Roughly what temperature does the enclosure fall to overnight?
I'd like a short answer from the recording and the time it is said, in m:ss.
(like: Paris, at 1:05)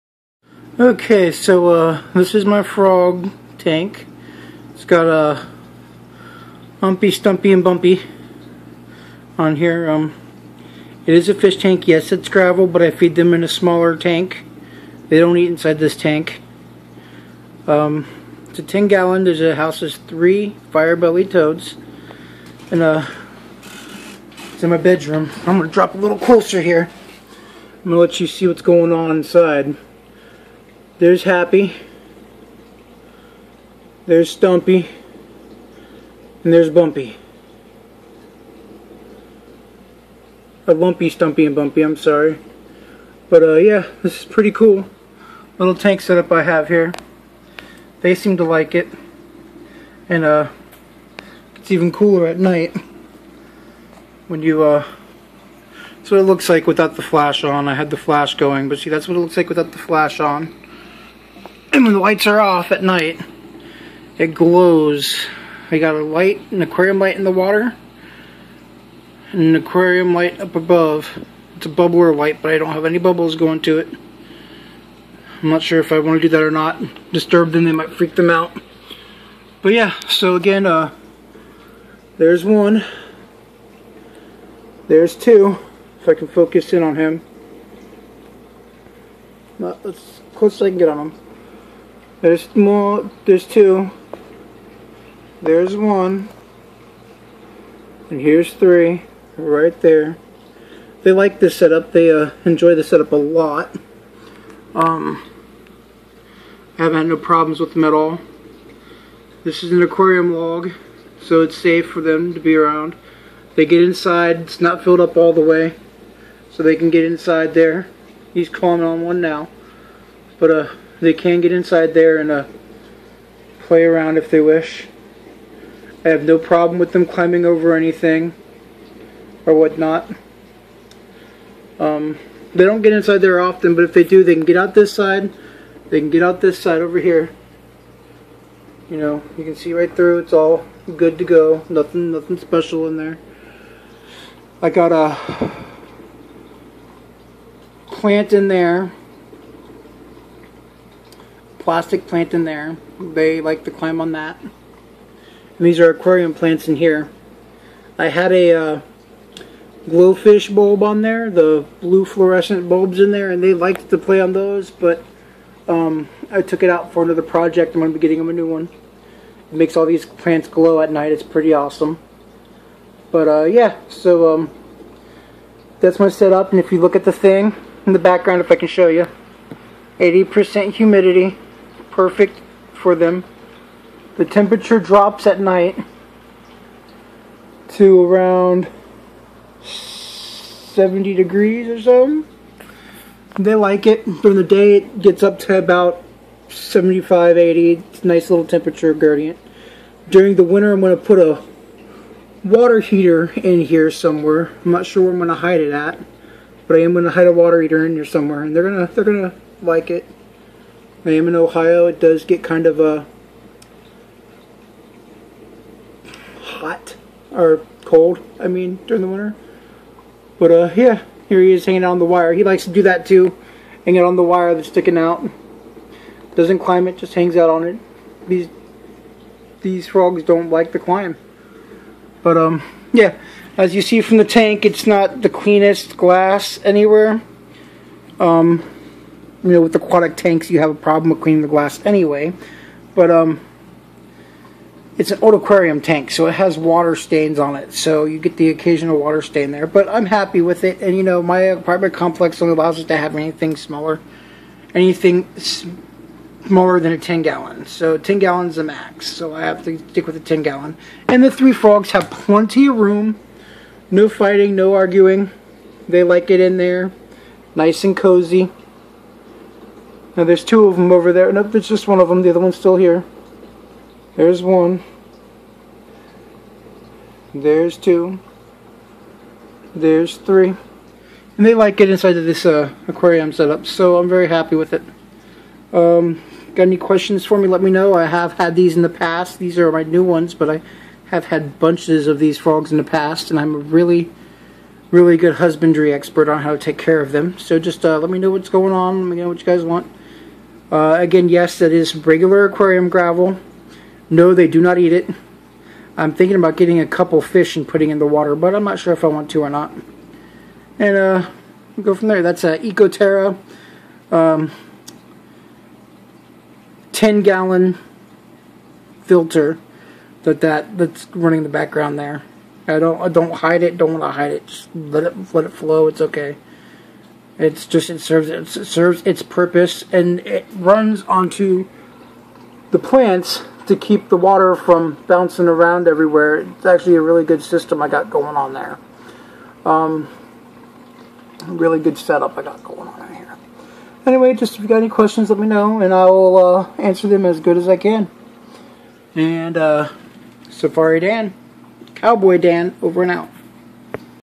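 70 degrees, at 3:09.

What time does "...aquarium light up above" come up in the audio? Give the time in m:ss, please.
1:09.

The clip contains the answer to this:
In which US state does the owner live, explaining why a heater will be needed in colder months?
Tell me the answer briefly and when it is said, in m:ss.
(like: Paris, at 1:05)
Ohio, at 3:31.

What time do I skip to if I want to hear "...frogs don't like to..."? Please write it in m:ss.
3:49.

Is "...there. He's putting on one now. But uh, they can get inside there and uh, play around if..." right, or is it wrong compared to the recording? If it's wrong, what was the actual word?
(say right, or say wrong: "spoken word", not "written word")
wrong: "climbing", not "putting".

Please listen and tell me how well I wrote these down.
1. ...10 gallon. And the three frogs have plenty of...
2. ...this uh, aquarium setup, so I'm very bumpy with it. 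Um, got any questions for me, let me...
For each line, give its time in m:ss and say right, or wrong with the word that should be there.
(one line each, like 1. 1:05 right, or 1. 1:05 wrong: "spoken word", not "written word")
1. 4:20 right
2. 4:42 wrong: "happy", not "bumpy".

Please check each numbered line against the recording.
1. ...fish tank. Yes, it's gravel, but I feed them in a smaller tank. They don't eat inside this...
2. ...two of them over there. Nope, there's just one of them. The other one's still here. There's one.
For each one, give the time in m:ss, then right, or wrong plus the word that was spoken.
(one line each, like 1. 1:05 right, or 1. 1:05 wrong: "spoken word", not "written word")
1. 0:11 right
2. 4:30 right.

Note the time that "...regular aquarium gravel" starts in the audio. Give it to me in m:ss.
5:01.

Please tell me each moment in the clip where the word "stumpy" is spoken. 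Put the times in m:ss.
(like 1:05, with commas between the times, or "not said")
0:07, 0:34, 0:41.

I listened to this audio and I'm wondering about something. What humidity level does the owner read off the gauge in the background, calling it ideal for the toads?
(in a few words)
80%.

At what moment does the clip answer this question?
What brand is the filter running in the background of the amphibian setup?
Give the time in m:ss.
5:12.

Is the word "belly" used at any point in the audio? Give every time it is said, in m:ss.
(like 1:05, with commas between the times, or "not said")
0:20.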